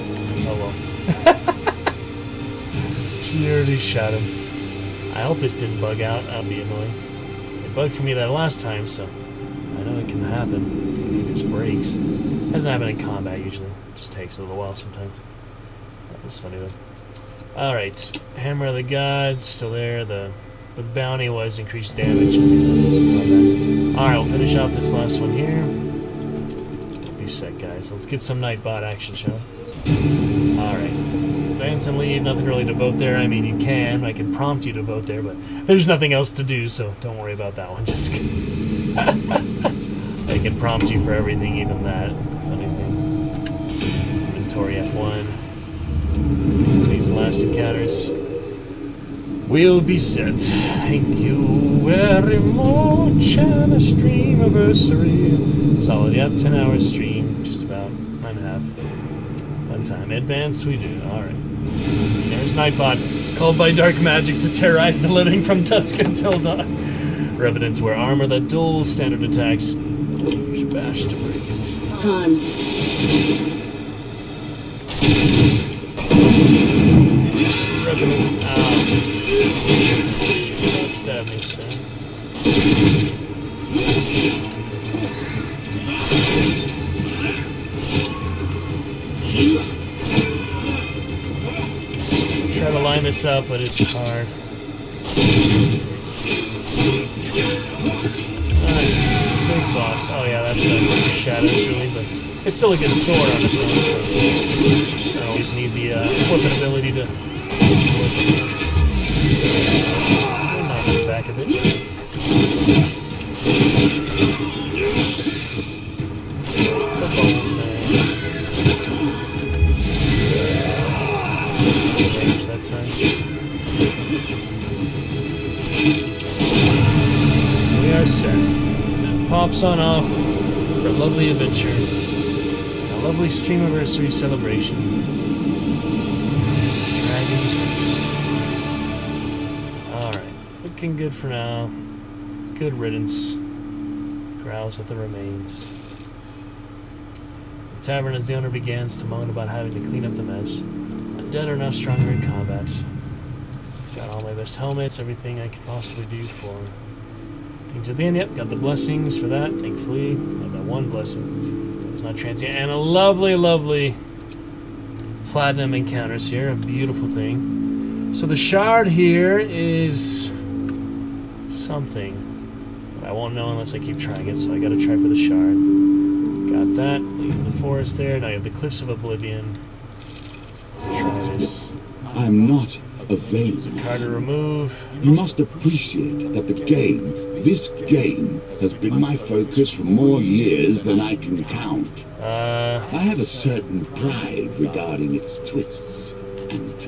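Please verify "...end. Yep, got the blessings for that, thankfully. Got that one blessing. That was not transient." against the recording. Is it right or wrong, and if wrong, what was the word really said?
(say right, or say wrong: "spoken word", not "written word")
right.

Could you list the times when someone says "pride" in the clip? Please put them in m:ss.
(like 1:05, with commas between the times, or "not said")
3:13.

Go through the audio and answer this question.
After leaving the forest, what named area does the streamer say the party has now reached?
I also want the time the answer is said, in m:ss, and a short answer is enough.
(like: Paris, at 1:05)
Cliffs of Oblivion, at 2:58.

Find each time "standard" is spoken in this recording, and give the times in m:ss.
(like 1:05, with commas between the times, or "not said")
1:08.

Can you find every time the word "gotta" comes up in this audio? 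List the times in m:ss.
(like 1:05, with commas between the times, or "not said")
2:54.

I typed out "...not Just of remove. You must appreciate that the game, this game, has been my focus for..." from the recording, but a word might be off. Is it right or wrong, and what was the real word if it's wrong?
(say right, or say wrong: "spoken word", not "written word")
wrong: "Kind", not "Just".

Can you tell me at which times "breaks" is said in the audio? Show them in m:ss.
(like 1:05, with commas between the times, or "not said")
0:11.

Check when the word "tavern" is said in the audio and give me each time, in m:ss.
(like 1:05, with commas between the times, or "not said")
2:27.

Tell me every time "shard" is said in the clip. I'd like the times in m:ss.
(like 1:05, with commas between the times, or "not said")
2:48, 2:55.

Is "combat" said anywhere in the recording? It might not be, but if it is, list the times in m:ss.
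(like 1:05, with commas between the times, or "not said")
0:12, 2:32.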